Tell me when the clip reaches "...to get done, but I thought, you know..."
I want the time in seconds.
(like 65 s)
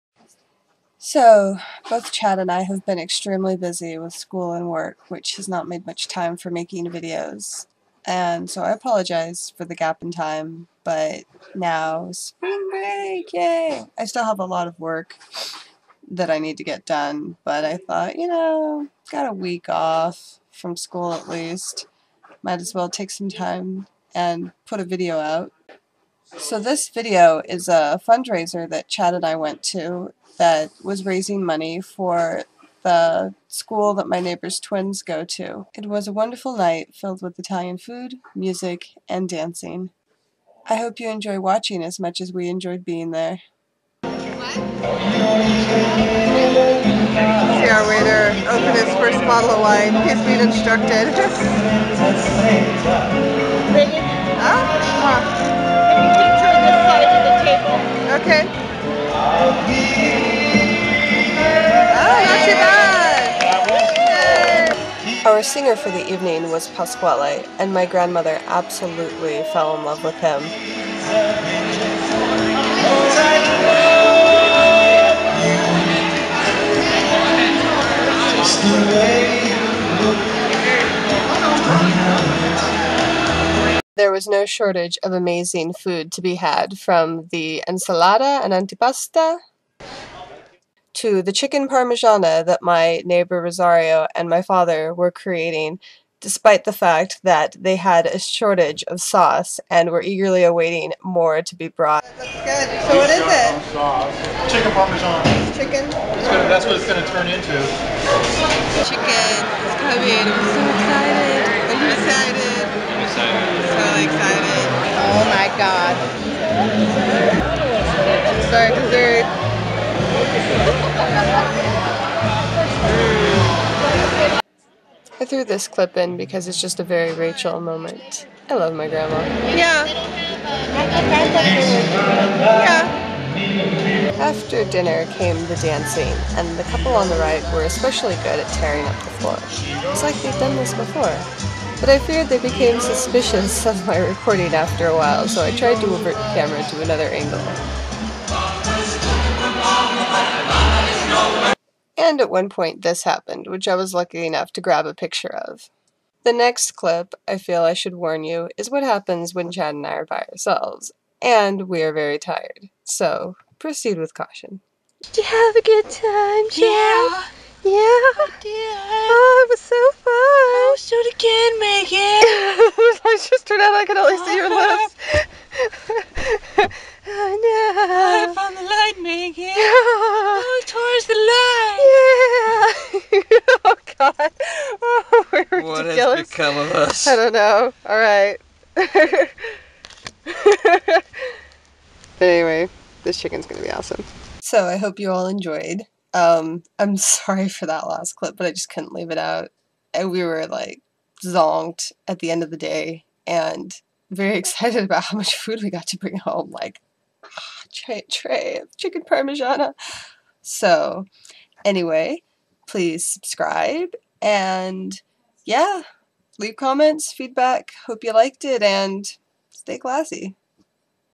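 16 s.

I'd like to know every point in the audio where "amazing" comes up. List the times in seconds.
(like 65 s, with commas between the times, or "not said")
85 s.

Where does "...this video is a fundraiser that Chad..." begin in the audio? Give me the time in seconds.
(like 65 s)
26 s.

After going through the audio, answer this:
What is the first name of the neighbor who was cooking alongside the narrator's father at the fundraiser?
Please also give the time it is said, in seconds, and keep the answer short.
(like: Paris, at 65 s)
Rosario, at 93 s.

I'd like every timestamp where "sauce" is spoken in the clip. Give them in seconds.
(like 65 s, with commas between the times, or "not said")
98 s, 103 s.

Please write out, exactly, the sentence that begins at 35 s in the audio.
It was a wonderful night filled with Italian food, music, and dancing.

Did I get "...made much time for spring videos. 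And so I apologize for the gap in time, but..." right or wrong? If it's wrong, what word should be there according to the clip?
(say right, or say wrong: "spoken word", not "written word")
wrong: "making", not "spring".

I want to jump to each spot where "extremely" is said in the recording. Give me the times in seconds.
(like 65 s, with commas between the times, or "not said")
2 s.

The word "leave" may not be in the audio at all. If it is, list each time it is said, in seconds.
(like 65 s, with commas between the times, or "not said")
198 s, 216 s.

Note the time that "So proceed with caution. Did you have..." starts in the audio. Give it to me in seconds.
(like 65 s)
162 s.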